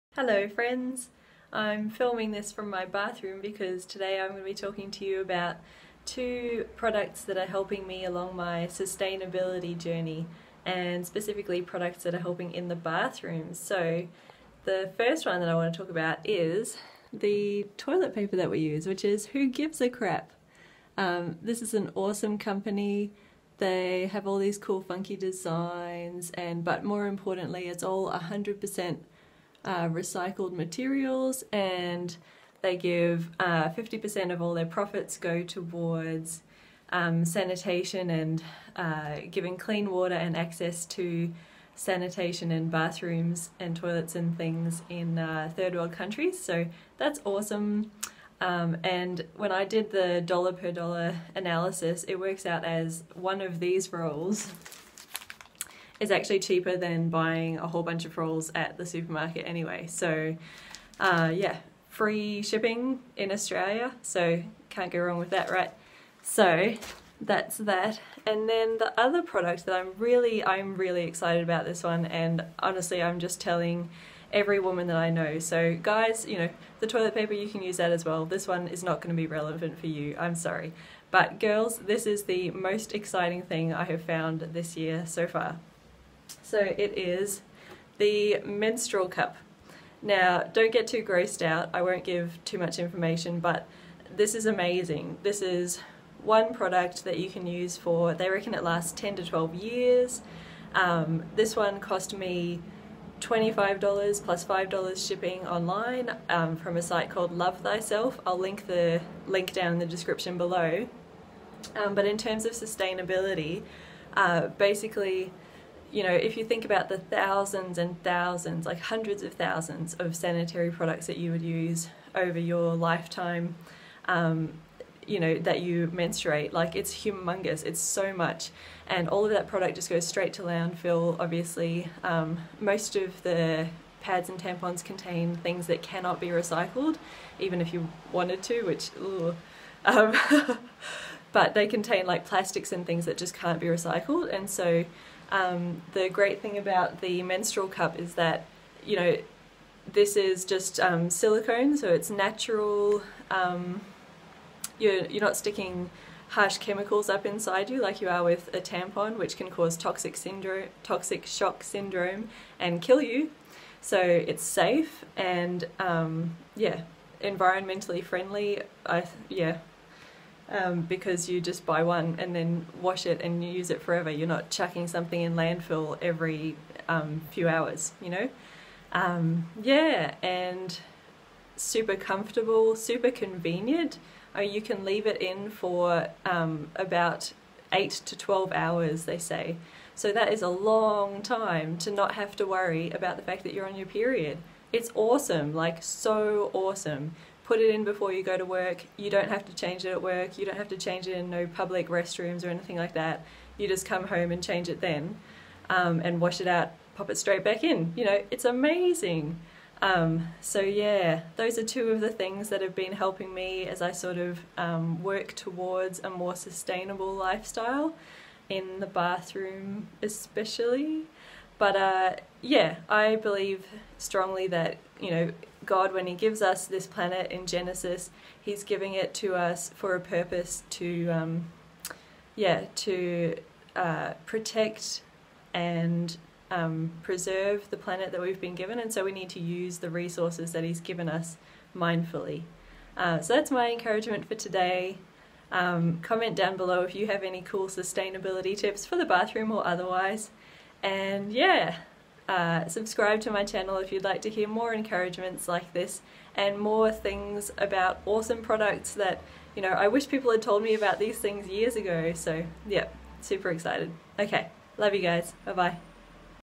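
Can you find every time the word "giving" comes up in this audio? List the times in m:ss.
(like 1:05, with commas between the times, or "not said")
0:39, 3:48.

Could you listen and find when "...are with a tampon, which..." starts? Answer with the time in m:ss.
2:38.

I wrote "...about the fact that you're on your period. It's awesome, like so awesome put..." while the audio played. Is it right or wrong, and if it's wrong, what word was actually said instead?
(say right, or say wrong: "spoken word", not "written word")
right.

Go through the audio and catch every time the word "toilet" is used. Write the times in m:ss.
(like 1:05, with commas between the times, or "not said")
0:17, 0:43, 1:16.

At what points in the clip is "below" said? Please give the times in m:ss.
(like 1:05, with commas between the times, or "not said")
1:50, 4:06.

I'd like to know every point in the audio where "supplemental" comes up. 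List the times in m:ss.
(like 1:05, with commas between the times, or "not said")
not said.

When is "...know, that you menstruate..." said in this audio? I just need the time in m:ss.
2:05.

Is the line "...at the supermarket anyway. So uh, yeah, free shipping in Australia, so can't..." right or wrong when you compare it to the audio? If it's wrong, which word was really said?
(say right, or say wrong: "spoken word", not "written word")
right.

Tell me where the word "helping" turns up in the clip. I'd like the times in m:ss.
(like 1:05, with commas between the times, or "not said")
0:07, 0:12, 3:32.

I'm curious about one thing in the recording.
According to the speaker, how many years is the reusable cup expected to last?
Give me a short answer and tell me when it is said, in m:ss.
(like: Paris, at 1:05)
10 to 12 years, at 1:38.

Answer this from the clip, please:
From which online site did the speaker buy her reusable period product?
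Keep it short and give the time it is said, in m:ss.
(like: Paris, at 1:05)
Love Thyself, at 1:47.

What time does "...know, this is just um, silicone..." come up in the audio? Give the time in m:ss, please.
2:28.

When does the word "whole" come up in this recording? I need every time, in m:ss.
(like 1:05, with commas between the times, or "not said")
0:57.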